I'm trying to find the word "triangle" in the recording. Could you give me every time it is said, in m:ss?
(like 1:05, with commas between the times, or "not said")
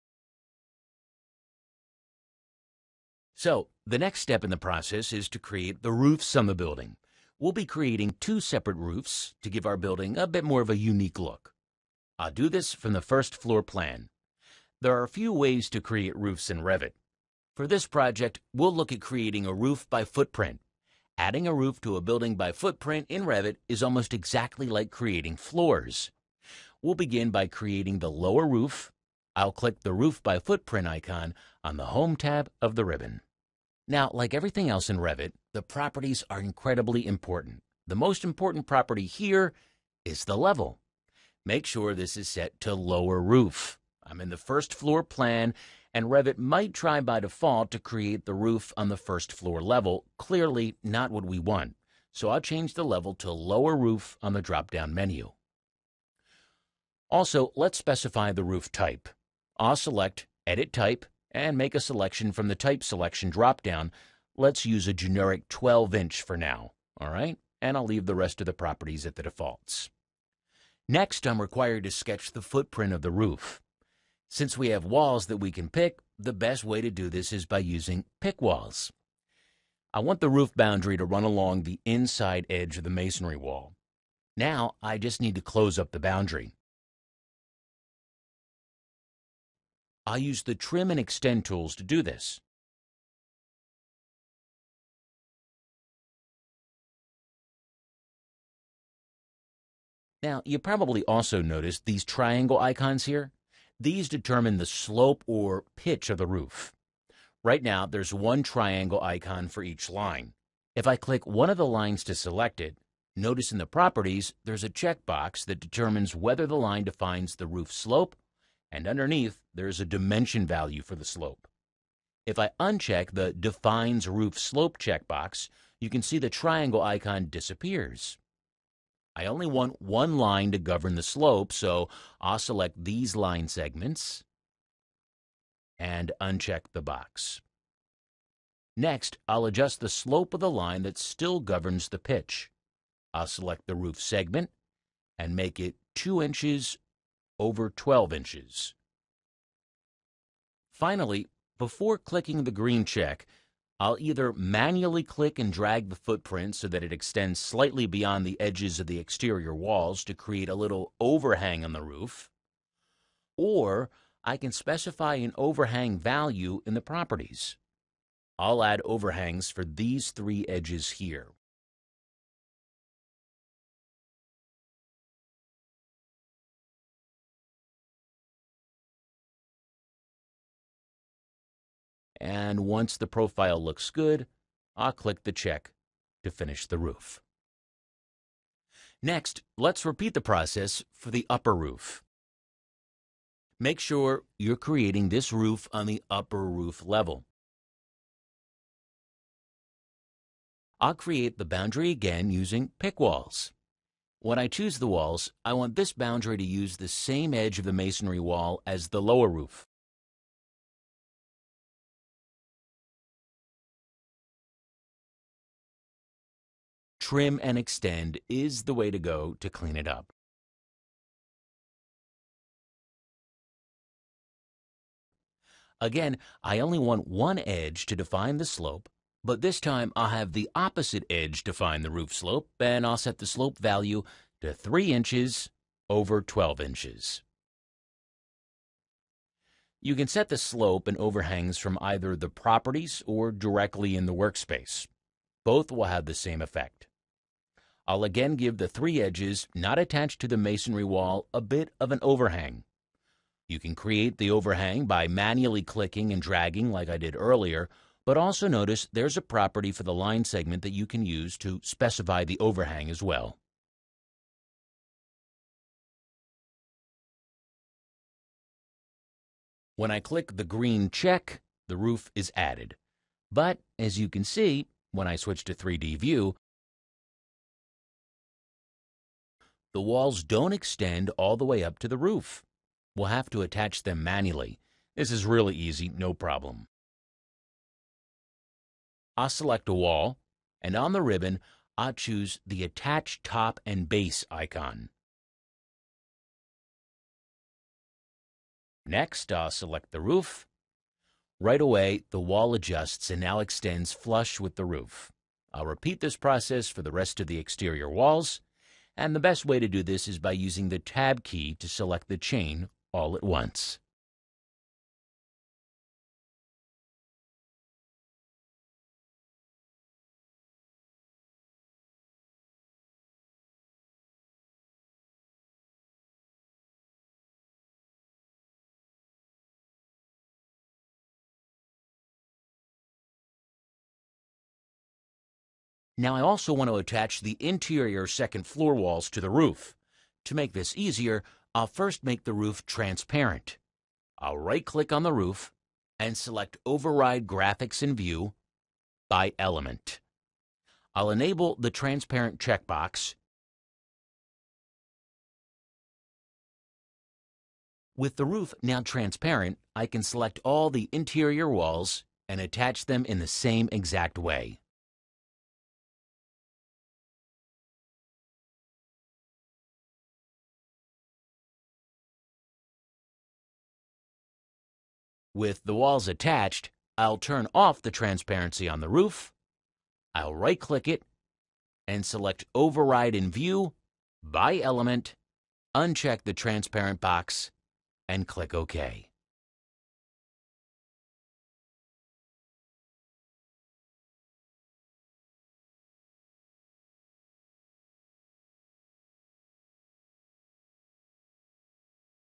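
1:42, 1:48, 2:06.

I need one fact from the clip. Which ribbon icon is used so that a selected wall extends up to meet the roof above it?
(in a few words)
Attach Top and Base.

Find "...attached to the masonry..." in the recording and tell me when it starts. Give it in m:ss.
4:09.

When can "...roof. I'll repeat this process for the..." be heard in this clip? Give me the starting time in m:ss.
5:04.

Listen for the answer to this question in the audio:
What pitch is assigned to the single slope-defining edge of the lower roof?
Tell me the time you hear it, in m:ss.
2:25.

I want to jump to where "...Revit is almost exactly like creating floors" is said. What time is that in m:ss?
0:23.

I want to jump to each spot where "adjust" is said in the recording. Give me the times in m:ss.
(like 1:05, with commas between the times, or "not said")
2:19, 5:02.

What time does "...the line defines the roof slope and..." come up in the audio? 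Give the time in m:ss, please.
1:56.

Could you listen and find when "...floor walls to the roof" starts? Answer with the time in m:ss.
5:38.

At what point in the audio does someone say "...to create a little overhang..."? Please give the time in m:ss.
2:40.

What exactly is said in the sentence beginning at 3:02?
and once the profile looks good, I'll click the check to finish the roof.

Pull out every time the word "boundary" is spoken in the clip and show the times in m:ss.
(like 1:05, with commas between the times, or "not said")
1:20, 1:25, 3:21, 3:25.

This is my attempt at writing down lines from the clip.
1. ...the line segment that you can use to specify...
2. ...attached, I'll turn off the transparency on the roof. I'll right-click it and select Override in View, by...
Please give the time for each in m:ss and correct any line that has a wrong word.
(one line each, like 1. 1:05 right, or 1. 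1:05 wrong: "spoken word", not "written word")
1. 4:19 right
2. 6:16 right.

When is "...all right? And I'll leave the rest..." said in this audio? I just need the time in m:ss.
1:06.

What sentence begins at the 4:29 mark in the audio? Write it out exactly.
When I click the green check, the roof is added.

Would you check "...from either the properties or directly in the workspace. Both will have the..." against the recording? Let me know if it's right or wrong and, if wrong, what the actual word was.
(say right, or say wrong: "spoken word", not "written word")
right.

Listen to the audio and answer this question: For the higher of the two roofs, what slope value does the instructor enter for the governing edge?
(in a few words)
3 inches over 12 inches.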